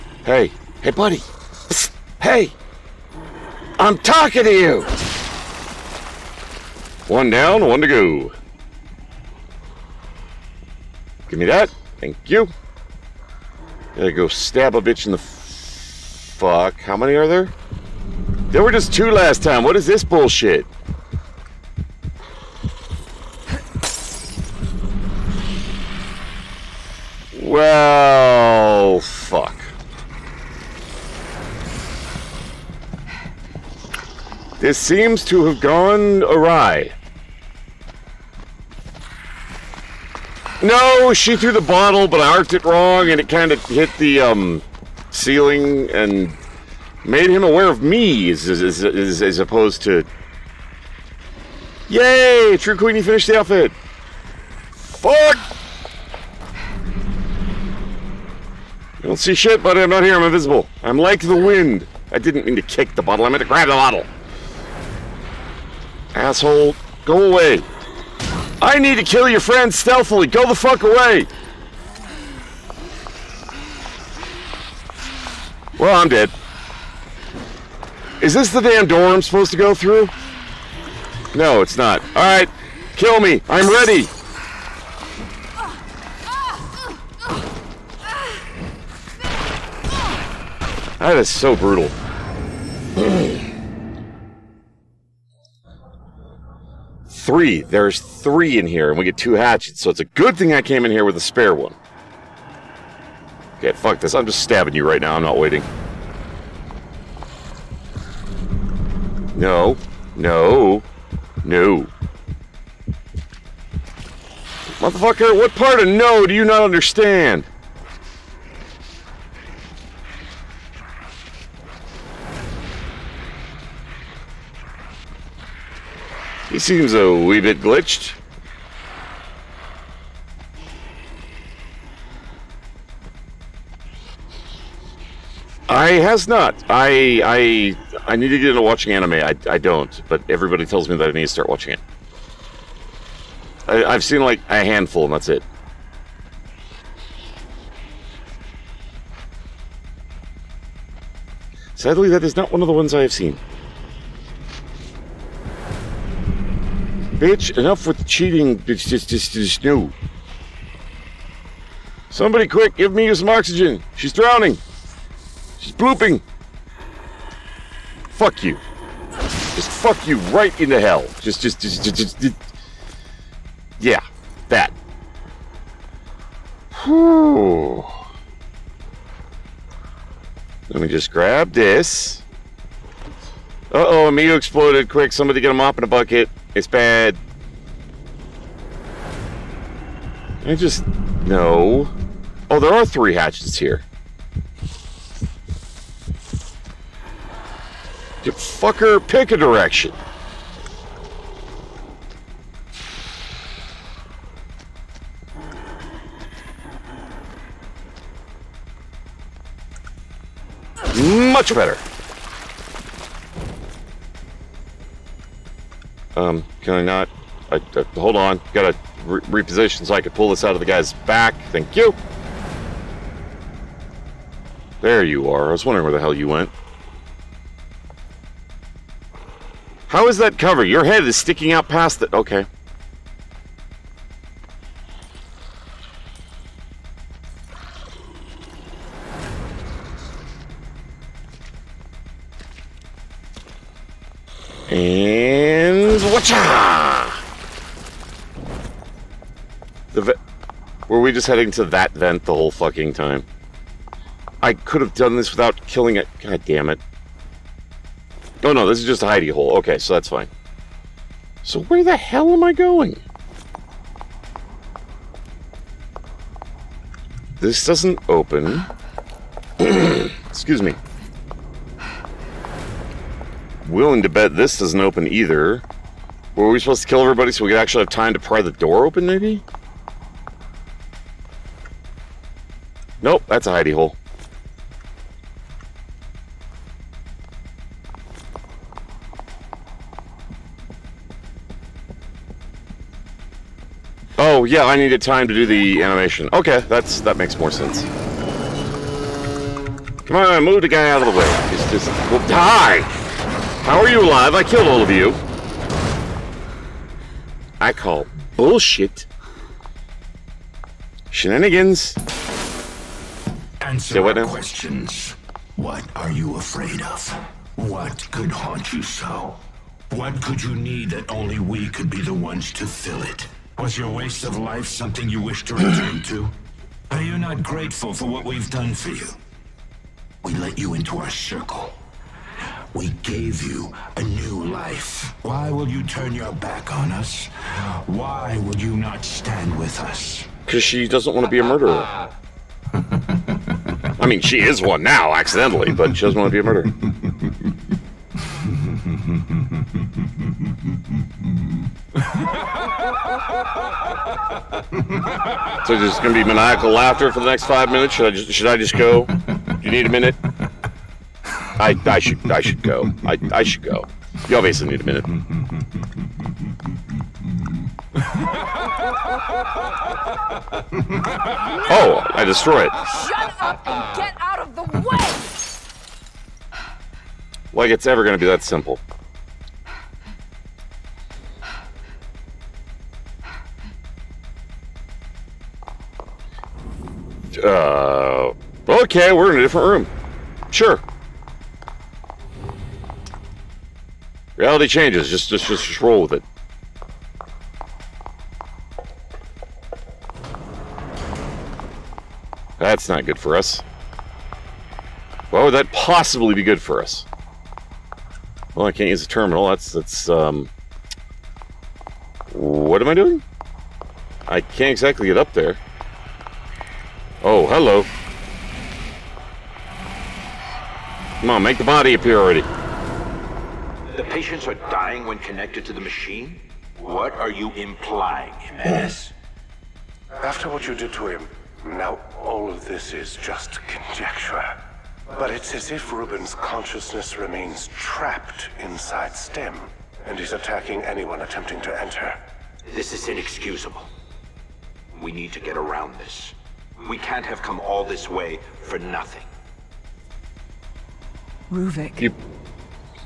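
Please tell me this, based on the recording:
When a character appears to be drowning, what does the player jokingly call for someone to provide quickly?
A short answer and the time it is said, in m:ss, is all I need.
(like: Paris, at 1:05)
Oxygen, at 2:43.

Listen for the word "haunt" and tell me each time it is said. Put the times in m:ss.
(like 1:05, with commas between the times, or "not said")
5:18.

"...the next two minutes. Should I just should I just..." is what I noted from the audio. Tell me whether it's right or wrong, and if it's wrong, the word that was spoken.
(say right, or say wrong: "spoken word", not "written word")
wrong: "five", not "two".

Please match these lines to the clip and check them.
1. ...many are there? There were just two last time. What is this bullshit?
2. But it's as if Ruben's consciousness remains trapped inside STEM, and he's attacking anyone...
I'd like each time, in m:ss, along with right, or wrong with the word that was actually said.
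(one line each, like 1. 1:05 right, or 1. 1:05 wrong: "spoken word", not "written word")
1. 0:16 right
2. 7:15 right.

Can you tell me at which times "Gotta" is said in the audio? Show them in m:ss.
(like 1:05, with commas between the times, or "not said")
0:13.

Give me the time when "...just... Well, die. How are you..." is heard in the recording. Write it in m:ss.
5:01.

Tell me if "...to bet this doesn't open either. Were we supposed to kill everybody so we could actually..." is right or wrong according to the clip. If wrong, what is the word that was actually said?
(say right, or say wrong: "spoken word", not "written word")
right.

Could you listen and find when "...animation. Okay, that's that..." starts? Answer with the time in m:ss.
4:55.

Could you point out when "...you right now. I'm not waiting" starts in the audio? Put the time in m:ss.
1:44.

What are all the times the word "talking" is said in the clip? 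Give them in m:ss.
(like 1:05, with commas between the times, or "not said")
0:03.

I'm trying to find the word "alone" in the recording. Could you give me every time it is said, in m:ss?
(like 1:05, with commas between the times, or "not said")
not said.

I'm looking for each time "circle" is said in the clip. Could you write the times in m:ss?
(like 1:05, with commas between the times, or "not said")
5:31.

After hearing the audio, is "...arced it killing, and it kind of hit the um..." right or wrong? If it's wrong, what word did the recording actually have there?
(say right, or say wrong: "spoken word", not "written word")
wrong: "wrong", not "killing".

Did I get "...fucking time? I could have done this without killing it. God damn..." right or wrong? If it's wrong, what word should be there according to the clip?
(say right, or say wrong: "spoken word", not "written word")
right.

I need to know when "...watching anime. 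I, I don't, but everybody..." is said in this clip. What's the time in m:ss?
2:18.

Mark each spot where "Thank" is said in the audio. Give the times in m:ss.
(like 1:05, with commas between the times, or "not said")
0:11, 3:41.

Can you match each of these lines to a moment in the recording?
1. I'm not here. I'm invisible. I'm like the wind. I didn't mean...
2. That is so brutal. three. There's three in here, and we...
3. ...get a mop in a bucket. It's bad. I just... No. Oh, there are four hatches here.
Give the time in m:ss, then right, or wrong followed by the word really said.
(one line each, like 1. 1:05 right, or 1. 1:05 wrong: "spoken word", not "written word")
1. 0:59 right
2. 1:31 right
3. 3:05 wrong: "three", not "four".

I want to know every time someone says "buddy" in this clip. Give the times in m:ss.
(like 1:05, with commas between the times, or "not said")
0:00, 0:59.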